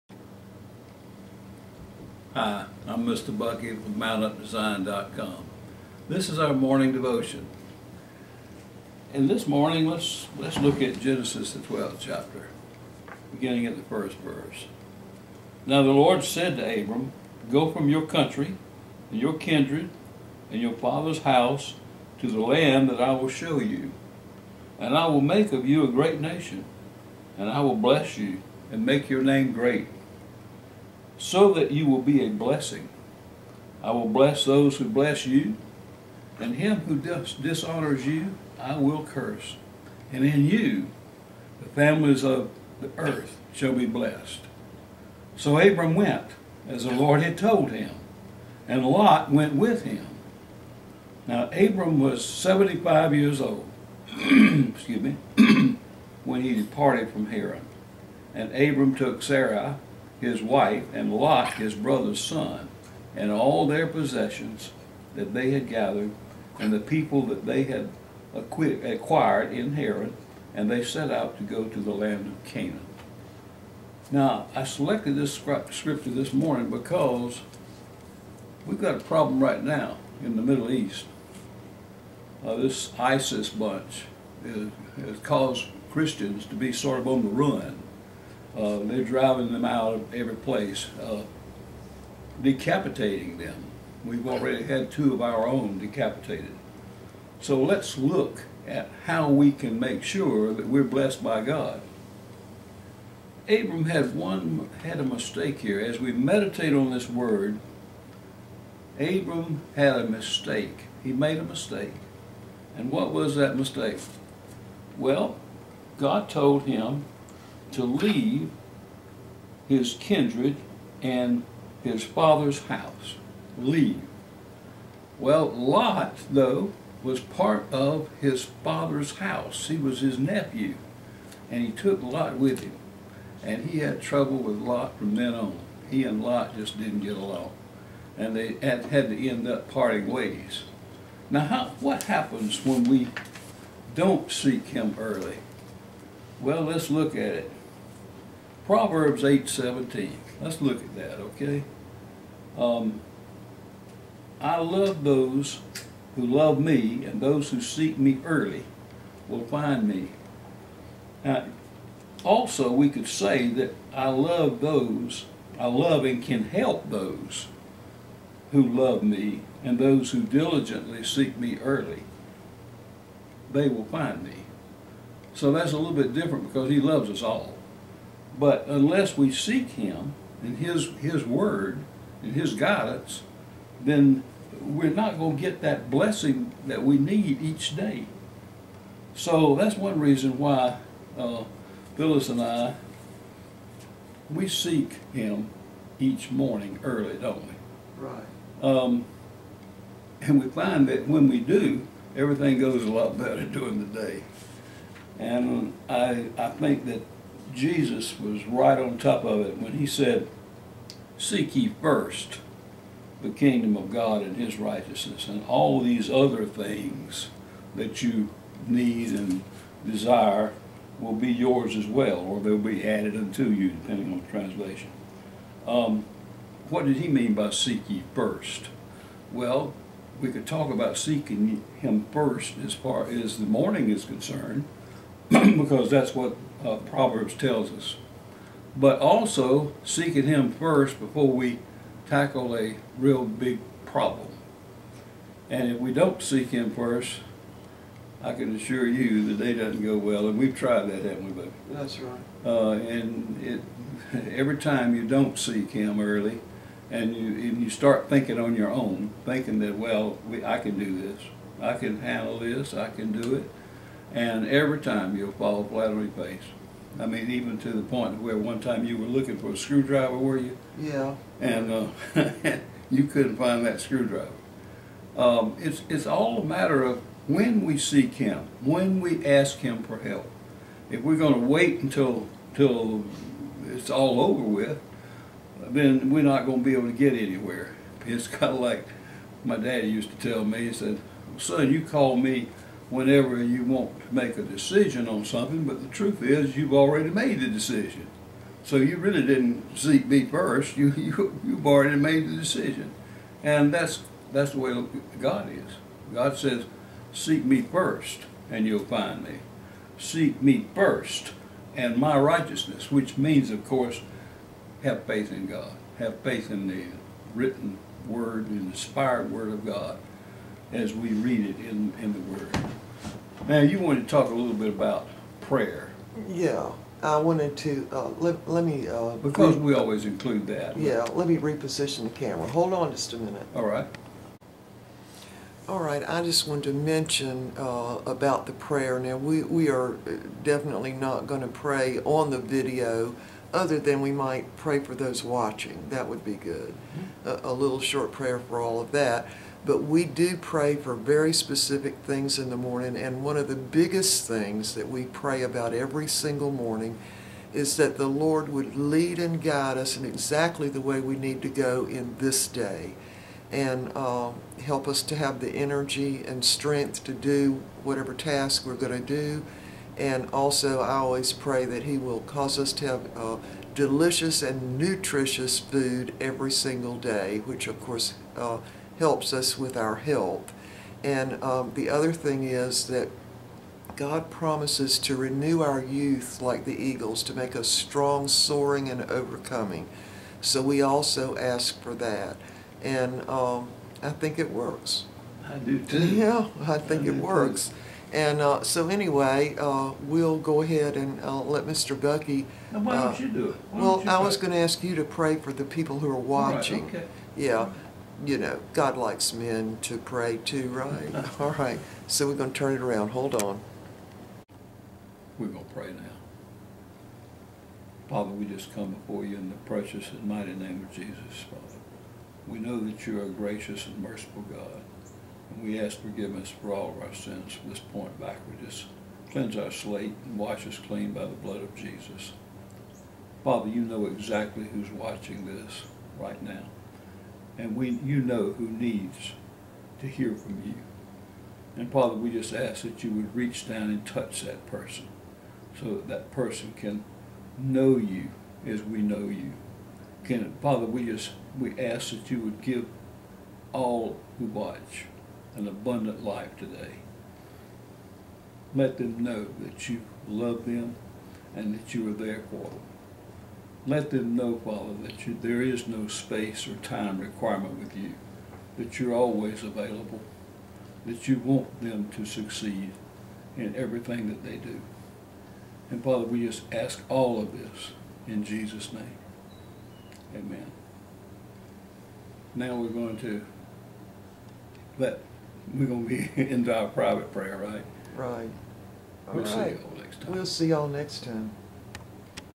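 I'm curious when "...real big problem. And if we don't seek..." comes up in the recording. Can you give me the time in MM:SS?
04:02.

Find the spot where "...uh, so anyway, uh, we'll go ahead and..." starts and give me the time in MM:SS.
06:38.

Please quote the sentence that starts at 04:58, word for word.
So you really didn't seek me first.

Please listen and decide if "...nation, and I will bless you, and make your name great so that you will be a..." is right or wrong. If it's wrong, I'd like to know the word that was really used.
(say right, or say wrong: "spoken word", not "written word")
right.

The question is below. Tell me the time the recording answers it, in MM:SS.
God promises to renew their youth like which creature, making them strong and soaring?
06:26.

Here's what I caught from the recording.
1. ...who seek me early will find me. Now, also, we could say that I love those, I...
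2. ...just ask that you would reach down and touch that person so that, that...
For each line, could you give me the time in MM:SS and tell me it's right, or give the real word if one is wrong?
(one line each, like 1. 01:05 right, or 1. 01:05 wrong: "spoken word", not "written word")
1. 02:37 right
2. 07:22 right.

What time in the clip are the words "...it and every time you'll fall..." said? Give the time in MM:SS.
04:23.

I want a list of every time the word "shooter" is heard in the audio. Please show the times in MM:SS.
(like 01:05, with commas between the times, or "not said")
not said.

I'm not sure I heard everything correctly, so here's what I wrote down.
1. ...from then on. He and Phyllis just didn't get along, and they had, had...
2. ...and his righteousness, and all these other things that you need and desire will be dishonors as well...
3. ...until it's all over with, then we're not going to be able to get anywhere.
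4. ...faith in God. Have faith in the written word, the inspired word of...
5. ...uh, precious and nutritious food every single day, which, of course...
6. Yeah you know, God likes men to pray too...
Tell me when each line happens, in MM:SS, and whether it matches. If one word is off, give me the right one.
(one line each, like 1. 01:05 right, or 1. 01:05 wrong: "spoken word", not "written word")
1. 02:14 wrong: "Lot", not "Phyllis"
2. 03:34 wrong: "yours", not "dishonors"
3. 04:42 right
4. 05:15 right
5. 06:13 wrong: "delicious", not "precious"
6. 06:47 right.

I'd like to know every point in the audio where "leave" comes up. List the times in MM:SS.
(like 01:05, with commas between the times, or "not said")
01:57, 02:03.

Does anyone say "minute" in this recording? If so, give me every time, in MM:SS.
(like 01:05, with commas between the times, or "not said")
05:33.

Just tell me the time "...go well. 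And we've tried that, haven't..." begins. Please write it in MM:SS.
04:09.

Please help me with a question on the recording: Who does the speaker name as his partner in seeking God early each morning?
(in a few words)
Phyllis.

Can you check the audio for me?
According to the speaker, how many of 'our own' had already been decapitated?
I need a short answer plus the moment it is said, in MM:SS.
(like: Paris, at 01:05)
2, at 01:34.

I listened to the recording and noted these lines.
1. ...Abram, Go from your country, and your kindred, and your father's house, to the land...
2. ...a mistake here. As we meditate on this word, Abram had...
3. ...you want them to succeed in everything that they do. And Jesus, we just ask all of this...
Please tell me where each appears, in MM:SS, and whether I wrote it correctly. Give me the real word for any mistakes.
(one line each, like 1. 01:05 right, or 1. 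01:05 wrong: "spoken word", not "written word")
1. 00:16 right
2. 01:44 right
3. 07:51 wrong: "Father", not "Jesus".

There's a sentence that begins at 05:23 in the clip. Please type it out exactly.
Now, you wanted to talk a little bit about prayer.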